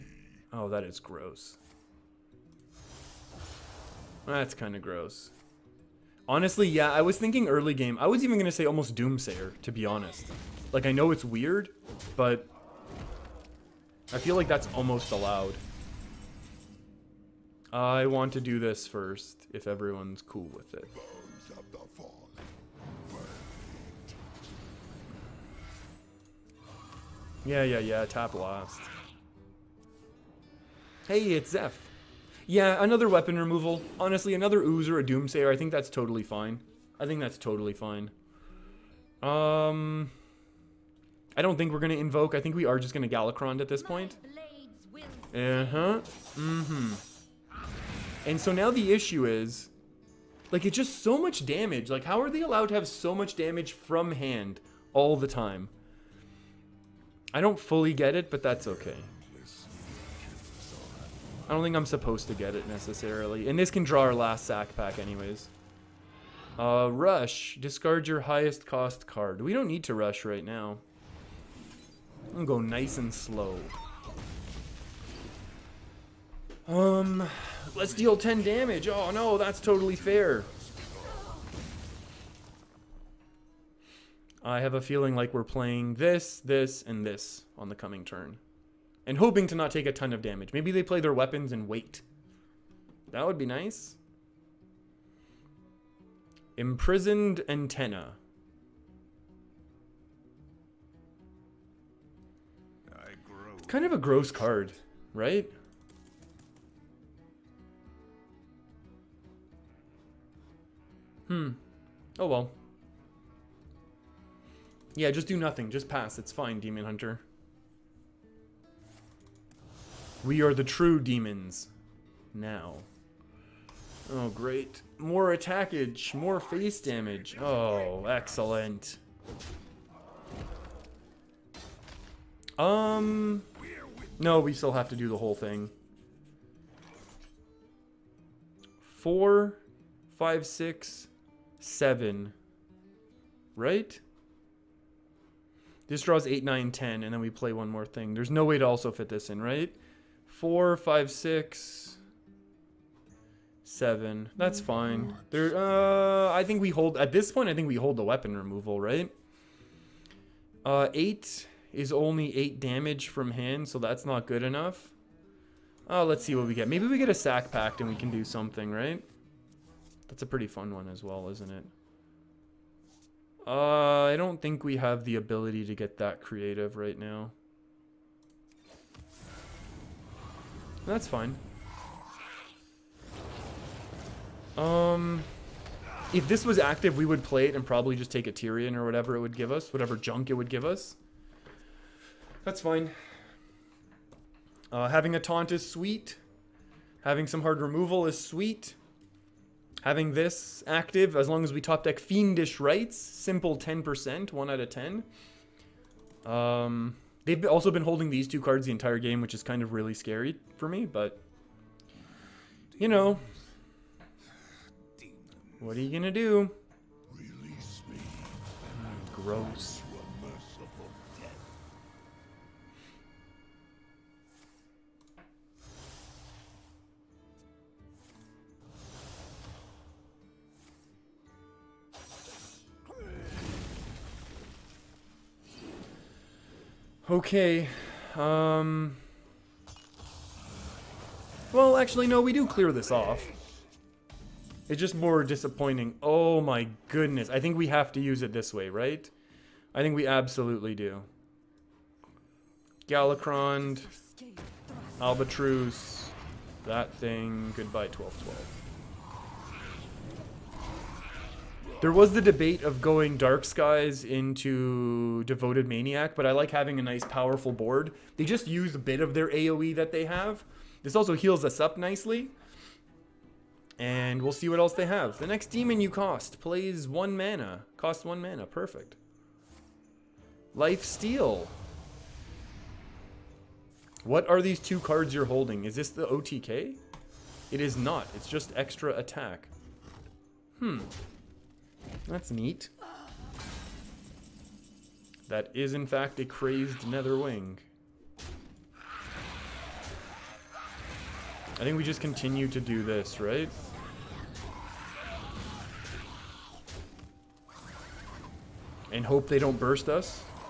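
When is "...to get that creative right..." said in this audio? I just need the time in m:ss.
2:55.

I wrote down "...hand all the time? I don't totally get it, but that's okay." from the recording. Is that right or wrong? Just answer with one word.
wrong.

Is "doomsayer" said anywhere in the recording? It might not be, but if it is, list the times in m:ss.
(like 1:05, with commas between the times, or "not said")
0:08, 0:35.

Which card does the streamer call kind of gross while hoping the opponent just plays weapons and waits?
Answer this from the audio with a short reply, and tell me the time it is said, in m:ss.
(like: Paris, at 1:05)
Imprisoned Antaen, at 1:36.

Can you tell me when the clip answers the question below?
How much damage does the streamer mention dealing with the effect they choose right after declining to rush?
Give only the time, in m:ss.
1:18.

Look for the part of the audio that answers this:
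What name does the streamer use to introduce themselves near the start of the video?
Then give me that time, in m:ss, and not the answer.
0:31.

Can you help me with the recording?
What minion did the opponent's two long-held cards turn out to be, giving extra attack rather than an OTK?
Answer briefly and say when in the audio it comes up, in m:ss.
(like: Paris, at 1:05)
Crazed Netherwing, at 4:56.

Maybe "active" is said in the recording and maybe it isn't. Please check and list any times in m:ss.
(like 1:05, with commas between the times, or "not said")
3:06, 3:20.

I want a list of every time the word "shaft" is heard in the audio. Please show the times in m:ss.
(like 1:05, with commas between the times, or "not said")
not said.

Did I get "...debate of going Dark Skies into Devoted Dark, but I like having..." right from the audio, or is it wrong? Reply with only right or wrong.
wrong.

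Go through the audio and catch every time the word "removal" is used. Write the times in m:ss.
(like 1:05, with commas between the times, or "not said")
0:33, 2:38, 3:17.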